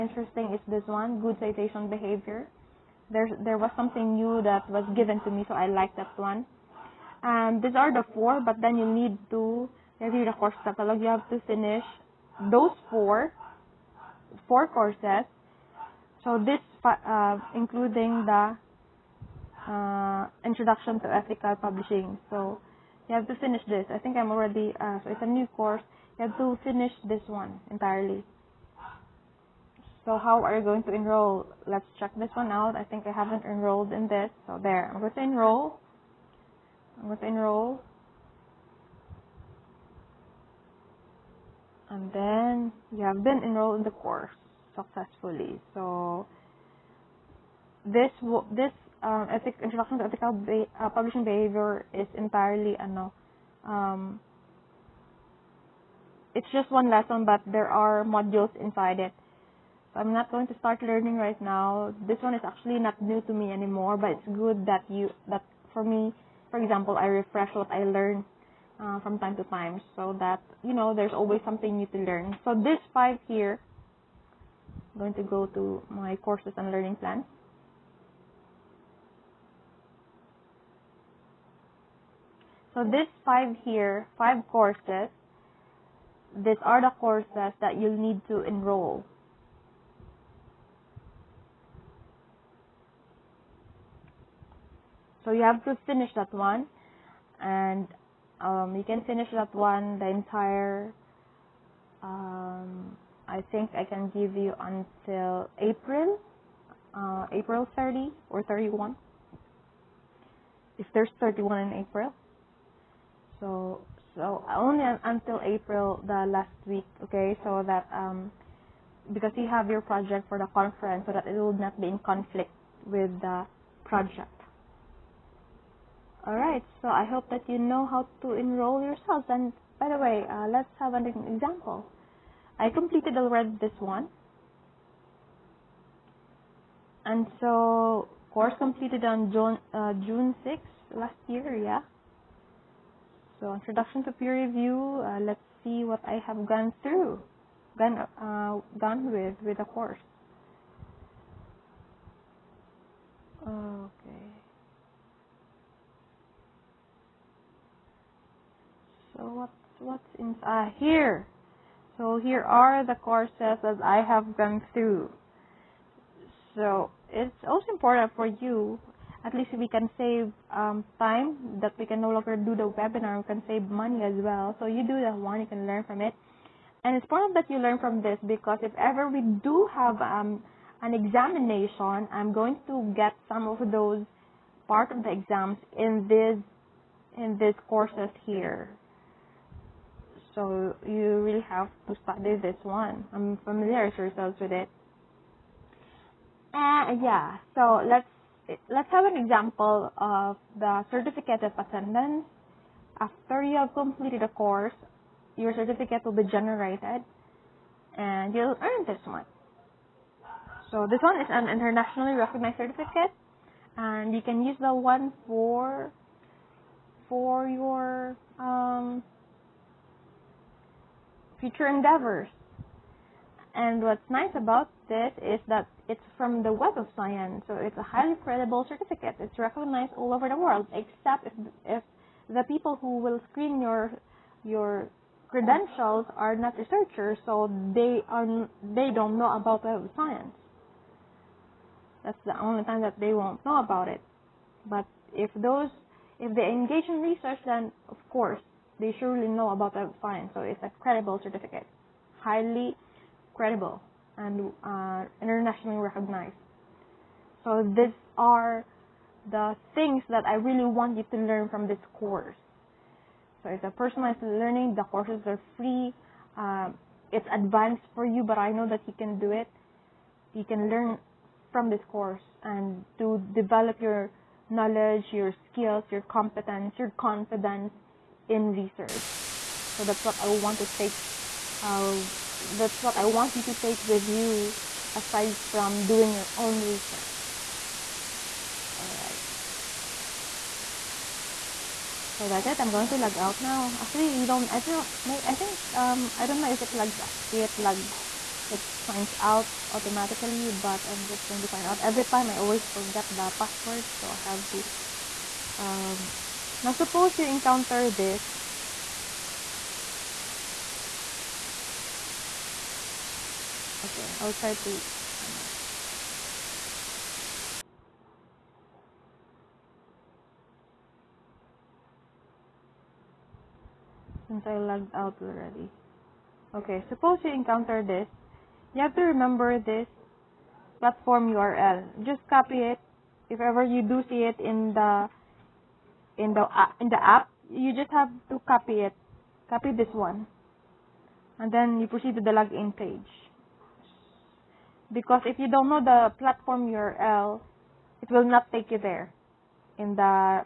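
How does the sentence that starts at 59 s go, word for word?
So I'm not going to start learning right now.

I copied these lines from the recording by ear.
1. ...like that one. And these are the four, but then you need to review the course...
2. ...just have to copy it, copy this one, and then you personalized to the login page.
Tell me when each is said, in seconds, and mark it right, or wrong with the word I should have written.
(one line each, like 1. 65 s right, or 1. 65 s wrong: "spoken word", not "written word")
1. 5 s right
2. 337 s wrong: "proceed", not "personalized".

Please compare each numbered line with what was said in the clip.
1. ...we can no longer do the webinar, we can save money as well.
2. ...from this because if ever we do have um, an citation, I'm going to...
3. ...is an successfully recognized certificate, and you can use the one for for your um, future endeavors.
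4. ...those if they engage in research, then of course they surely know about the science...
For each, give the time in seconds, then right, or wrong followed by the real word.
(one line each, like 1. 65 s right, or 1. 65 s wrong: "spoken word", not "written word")
1. 171 s right
2. 177 s wrong: "examination", not "citation"
3. 211 s wrong: "internationally", not "successfully"
4. 245 s right.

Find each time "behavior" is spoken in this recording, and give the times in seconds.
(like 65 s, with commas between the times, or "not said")
1 s, 51 s.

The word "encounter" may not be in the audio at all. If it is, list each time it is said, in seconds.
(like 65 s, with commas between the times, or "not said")
307 s, 327 s.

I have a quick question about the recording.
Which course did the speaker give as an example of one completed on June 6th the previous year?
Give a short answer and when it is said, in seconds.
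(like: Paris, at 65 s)
Introduction to peer review, at 143 s.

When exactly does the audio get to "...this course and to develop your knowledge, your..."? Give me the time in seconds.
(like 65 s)
271 s.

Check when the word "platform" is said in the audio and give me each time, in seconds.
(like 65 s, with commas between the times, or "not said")
330 s, 346 s.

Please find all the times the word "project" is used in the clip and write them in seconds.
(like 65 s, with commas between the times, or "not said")
119 s, 123 s.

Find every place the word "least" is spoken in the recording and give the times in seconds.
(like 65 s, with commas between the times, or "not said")
169 s.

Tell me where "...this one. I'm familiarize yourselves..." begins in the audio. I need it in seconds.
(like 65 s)
192 s.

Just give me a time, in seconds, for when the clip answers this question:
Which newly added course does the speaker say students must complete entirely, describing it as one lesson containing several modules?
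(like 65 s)
20 s.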